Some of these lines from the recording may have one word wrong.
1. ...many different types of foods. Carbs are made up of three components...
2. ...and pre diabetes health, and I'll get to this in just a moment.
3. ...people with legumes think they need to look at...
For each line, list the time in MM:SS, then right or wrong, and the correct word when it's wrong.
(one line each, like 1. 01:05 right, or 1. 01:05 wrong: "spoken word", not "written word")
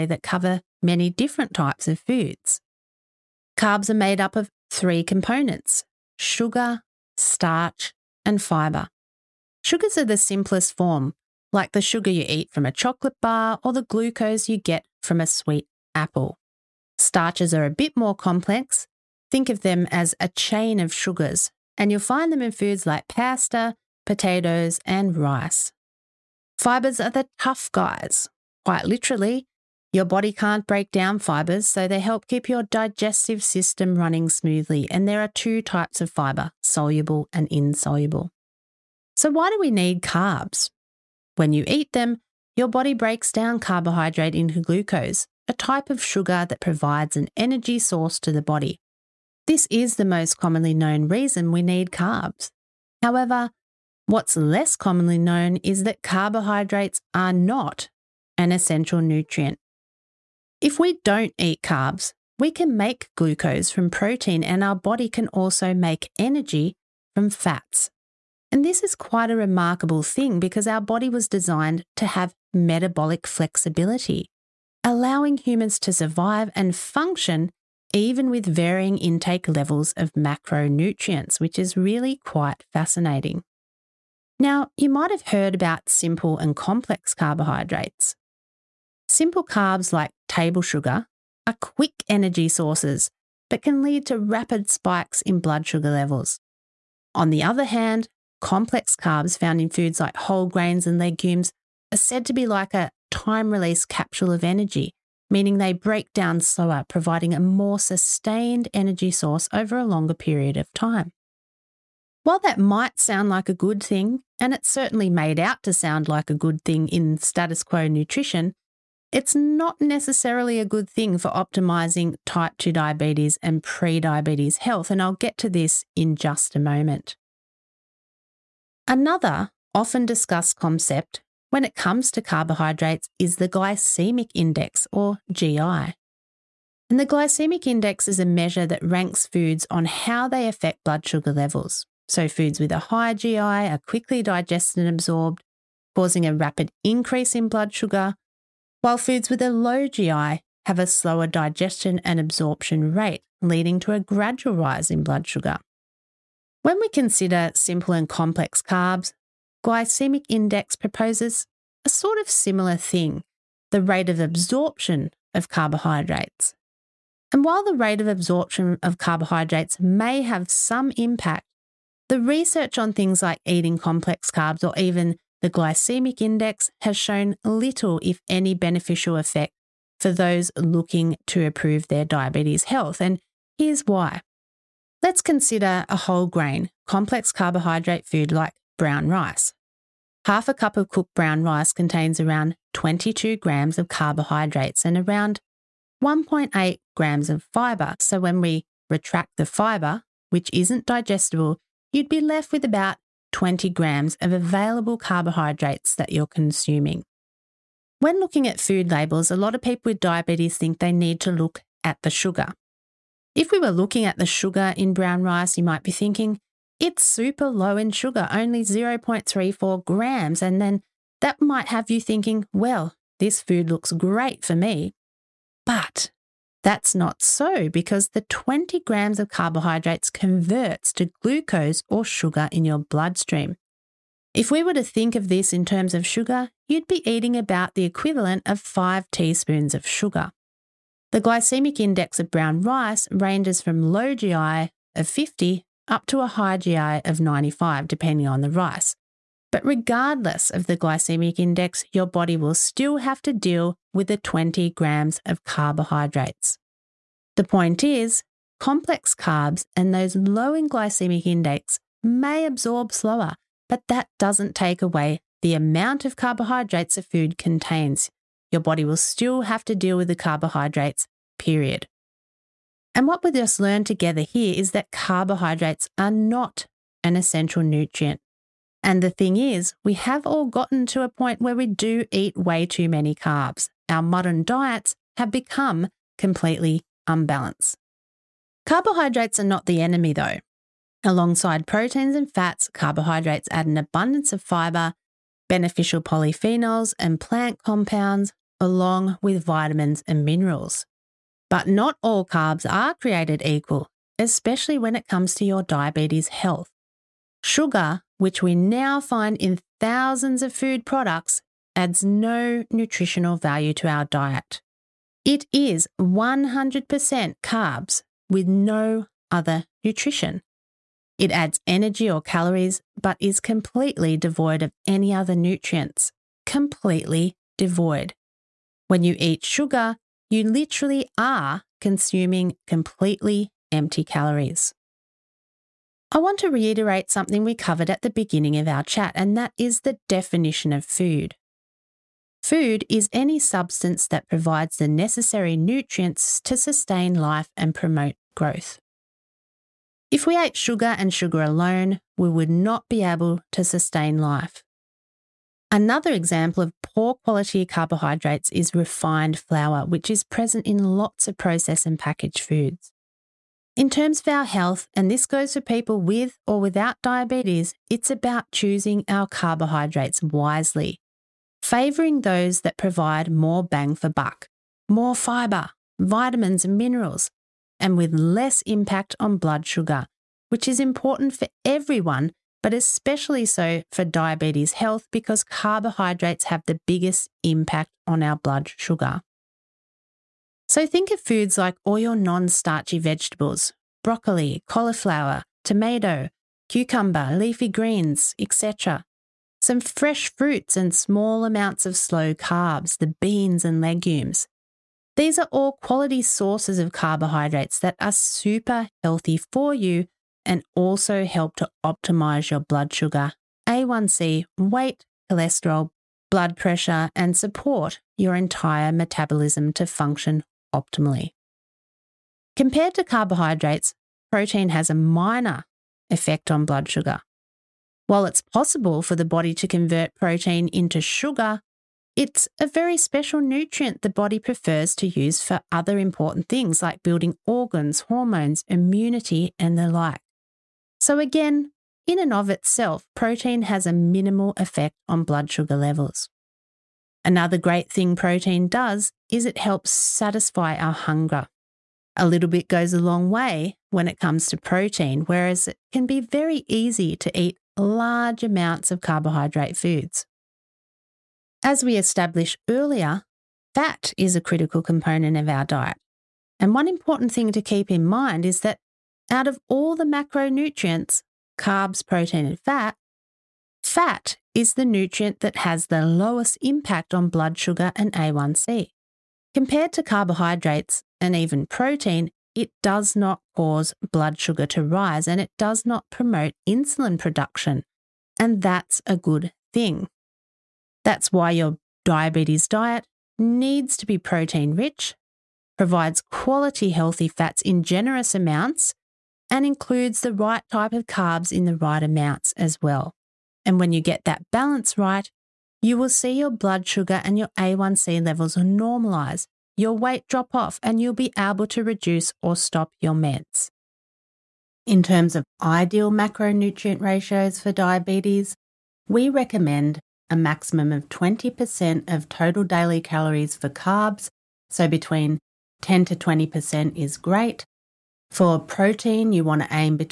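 1. 00:00 right
2. 02:03 right
3. 03:29 wrong: "diabetes", not "legumes".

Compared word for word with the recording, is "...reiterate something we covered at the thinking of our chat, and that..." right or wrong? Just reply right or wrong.
wrong.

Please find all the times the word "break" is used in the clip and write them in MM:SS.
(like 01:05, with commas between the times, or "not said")
00:30, 00:42, 01:45.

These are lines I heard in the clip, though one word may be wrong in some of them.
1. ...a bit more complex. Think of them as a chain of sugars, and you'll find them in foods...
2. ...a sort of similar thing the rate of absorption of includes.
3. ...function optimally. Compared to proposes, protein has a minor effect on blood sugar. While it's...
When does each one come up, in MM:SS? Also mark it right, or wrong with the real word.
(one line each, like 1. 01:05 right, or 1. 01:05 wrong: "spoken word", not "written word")
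1. 00:17 right
2. 02:41 wrong: "carbohydrates", not "includes"
3. 06:59 wrong: "carbohydrates", not "proposes".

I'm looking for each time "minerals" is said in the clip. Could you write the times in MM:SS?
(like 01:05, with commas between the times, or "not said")
05:00, 06:16.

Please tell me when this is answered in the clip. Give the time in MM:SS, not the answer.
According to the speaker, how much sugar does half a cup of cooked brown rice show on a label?
03:38.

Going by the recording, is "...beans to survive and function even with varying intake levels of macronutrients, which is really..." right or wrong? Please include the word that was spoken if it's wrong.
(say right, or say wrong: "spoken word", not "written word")
wrong: "humans", not "beans".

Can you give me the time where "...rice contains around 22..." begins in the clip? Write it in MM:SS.
03:11.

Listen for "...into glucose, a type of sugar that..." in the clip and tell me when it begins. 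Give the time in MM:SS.
00:44.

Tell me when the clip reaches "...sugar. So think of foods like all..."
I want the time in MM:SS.
06:28.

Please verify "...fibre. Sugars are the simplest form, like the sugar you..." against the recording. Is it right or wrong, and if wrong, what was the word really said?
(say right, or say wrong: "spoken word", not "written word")
right.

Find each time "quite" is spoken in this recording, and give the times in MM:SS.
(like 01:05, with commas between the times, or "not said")
00:28, 01:08, 01:22.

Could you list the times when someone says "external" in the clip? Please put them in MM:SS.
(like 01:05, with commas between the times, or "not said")
not said.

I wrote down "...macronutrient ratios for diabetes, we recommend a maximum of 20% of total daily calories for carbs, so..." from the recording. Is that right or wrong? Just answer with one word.
right.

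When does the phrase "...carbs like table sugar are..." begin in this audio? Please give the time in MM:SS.
01:29.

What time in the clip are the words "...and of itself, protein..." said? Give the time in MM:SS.
07:22.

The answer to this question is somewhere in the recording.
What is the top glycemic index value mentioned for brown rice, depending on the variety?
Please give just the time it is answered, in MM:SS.
04:07.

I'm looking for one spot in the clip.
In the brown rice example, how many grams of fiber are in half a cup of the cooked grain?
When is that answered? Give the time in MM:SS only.
03:16.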